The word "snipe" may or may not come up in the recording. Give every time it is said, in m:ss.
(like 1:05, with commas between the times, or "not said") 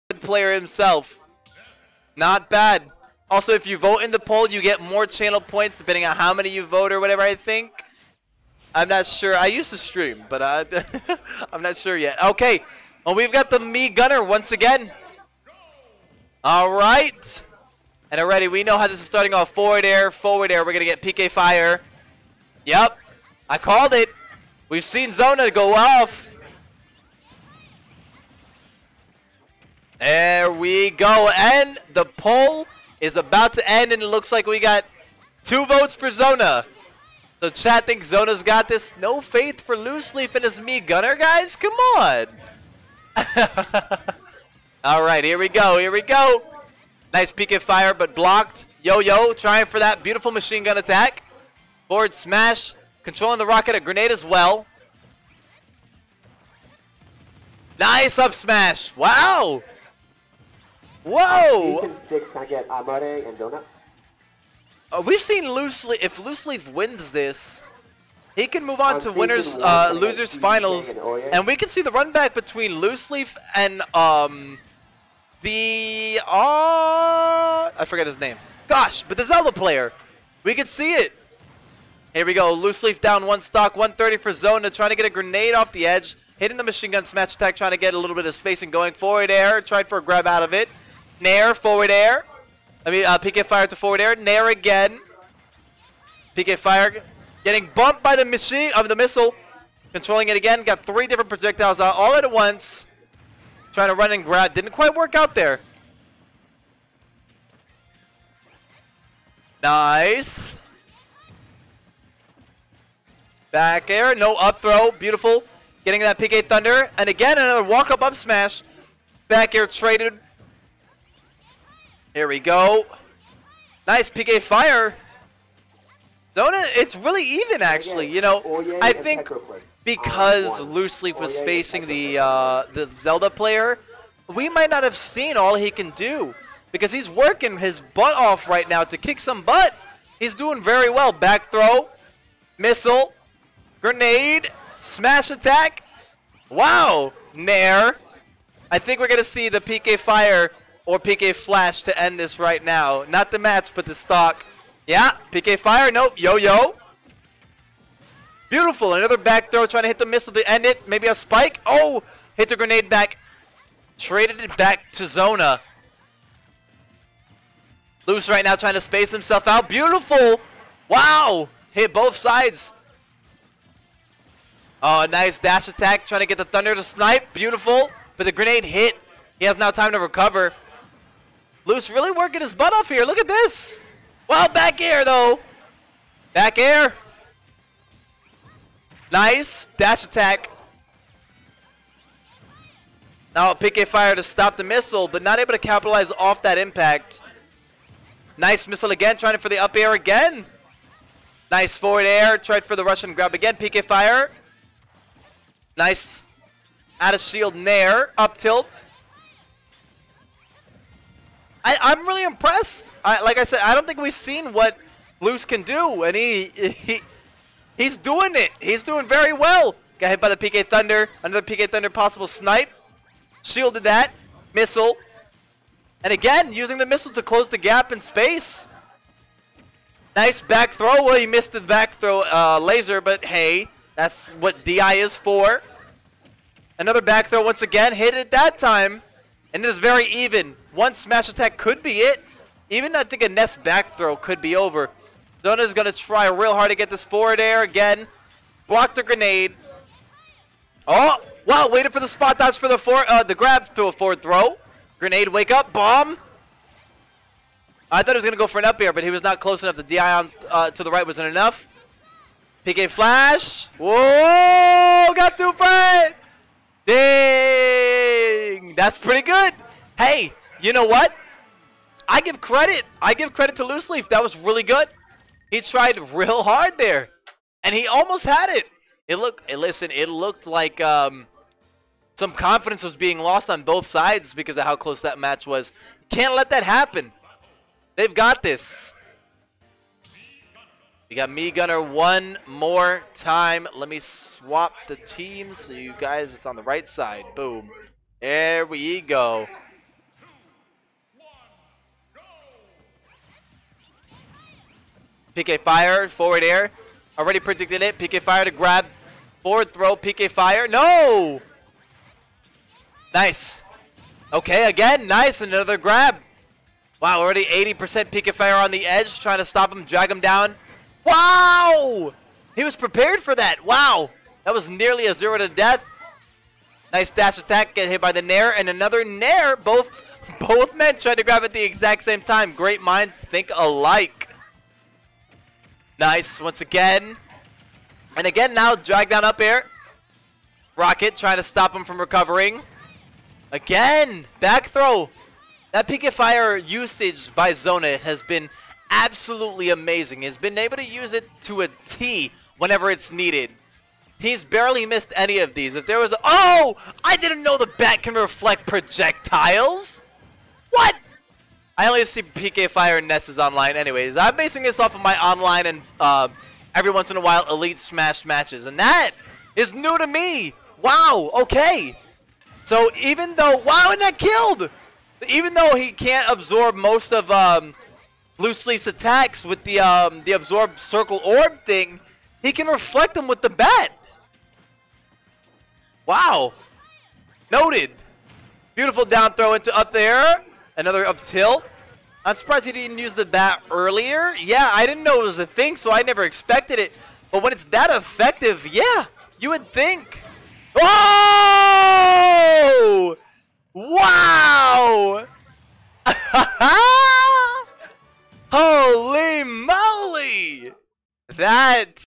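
2:56, 3:42.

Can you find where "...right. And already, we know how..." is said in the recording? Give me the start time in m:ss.
0:16.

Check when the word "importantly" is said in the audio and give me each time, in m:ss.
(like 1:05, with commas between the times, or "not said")
not said.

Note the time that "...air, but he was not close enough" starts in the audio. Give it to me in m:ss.
4:18.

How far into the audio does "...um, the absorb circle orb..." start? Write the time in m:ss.
6:19.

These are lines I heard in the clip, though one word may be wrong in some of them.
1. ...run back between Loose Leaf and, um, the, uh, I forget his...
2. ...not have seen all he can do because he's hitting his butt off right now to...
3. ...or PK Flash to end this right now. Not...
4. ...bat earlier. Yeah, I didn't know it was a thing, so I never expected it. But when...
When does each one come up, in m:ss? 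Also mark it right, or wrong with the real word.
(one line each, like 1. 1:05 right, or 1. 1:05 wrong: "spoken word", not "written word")
1. 1:11 right
2. 2:14 wrong: "working", not "hitting"
3. 2:30 right
4. 6:33 right.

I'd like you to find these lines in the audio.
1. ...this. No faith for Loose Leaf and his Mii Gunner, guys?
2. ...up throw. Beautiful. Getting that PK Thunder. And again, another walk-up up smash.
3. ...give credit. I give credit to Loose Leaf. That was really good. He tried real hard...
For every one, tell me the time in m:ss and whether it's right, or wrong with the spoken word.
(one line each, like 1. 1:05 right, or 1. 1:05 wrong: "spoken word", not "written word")
1. 0:38 right
2. 1:54 right
3. 4:32 right.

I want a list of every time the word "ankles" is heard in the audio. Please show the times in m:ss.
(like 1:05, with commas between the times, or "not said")
not said.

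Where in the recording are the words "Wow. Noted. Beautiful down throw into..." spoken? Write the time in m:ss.
6:26.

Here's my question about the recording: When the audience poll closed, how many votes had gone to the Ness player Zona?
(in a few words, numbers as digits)
2.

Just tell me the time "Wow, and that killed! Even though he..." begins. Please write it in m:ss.
6:13.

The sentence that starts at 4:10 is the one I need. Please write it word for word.
Oh, wow, waited for the spot dodge for the for uh, the grab to a forward throw.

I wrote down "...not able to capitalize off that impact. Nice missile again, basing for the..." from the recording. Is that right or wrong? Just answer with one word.
wrong.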